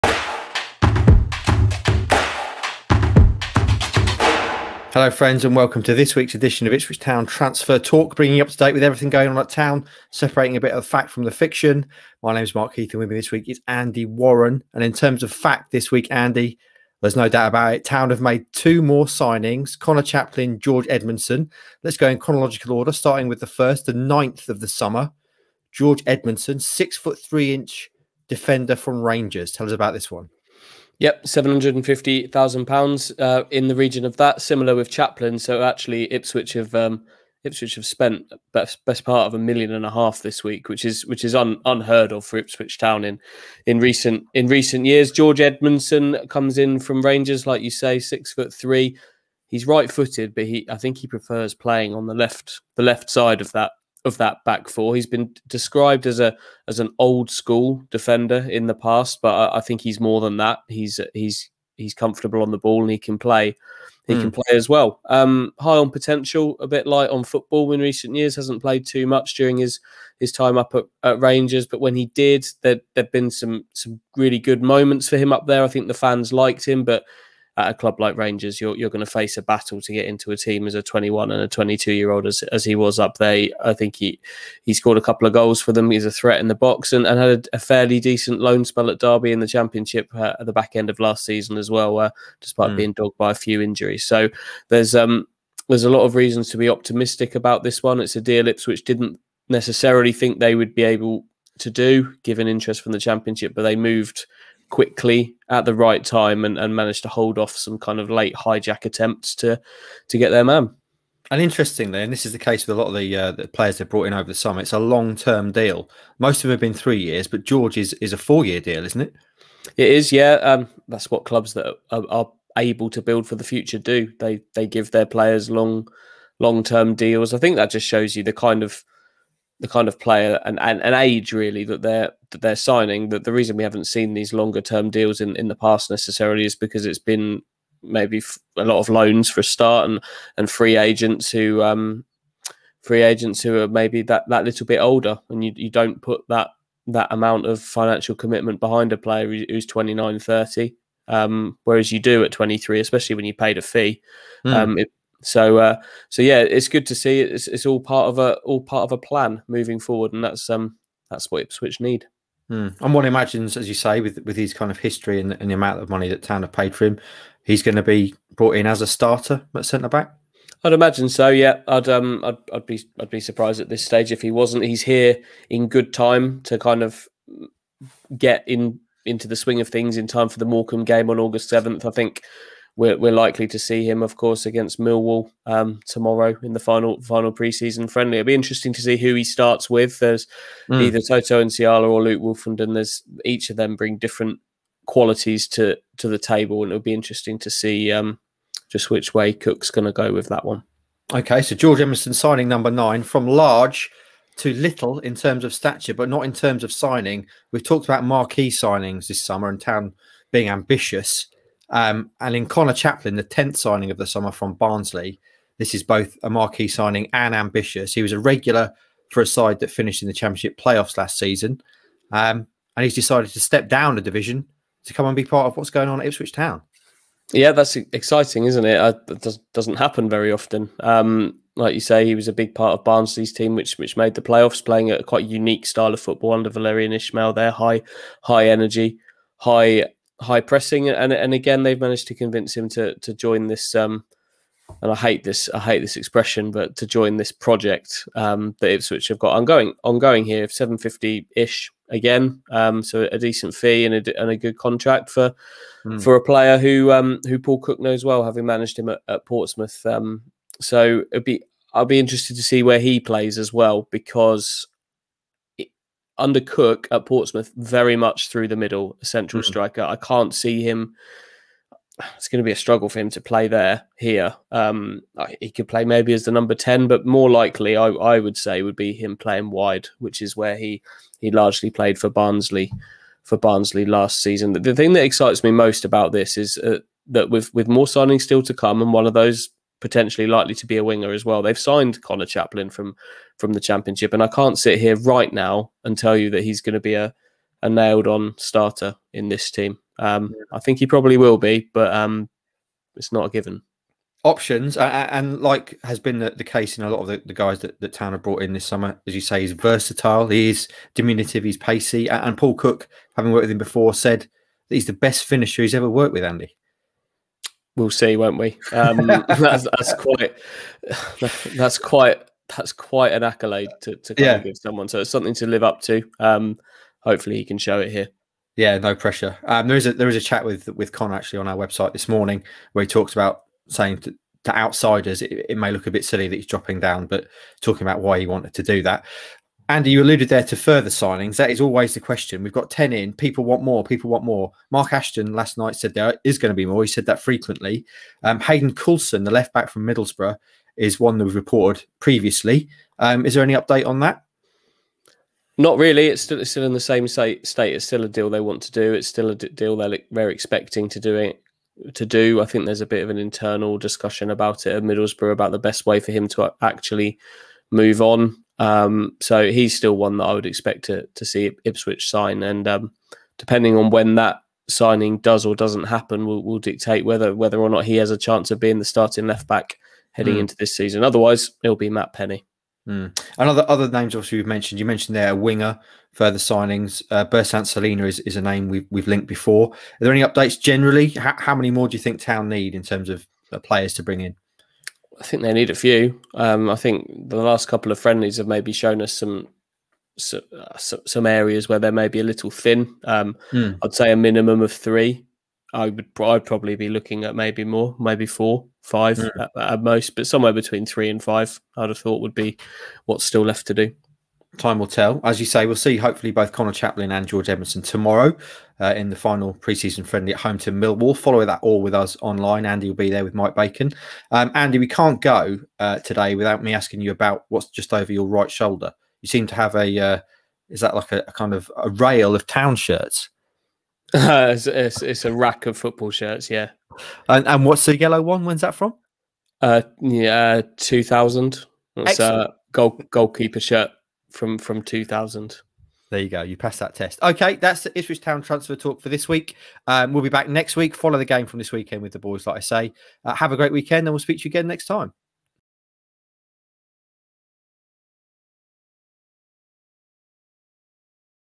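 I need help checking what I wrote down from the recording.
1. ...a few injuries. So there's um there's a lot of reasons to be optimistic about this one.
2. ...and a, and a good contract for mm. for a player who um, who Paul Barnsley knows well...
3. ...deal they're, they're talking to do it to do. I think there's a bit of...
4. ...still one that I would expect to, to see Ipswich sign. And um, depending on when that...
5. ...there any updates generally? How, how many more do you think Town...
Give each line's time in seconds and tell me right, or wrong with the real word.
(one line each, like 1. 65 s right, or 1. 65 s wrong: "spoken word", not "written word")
1. 93 s right
2. 253 s wrong: "Cook", not "Barnsley"
3. 359 s wrong: "expecting", not "talking"
4. 369 s right
5. 390 s right.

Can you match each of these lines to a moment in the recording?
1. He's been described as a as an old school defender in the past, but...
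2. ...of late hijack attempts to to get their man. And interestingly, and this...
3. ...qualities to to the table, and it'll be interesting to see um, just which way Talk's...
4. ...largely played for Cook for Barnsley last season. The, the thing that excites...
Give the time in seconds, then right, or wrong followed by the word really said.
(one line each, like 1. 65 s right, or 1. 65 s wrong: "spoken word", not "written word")
1. 54 s right
2. 107 s right
3. 194 s wrong: "Cook", not "Talk"
4. 281 s wrong: "Barnsley", not "Cook".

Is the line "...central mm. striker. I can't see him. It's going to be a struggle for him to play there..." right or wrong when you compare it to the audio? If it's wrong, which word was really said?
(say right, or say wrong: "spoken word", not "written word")
right.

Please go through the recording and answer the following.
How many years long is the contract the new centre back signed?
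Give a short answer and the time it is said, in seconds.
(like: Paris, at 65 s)
4, at 118 s.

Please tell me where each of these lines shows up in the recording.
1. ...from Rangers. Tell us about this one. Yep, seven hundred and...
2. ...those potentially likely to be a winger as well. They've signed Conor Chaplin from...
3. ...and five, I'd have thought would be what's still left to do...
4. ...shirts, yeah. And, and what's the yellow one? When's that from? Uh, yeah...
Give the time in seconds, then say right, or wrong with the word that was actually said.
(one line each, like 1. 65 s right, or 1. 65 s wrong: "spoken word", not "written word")
1. 28 s right
2. 289 s right
3. 411 s right
4. 436 s right.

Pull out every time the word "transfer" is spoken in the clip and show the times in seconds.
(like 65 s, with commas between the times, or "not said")
7 s, 448 s.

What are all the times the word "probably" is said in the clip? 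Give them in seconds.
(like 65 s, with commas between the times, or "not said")
300 s, 406 s.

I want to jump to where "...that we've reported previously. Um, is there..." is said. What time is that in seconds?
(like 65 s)
351 s.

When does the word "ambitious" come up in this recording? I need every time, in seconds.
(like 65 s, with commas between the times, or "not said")
210 s, 217 s.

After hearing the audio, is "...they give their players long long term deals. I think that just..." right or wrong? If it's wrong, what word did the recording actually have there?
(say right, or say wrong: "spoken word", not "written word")
right.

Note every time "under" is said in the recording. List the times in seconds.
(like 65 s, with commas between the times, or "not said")
236 s, 266 s.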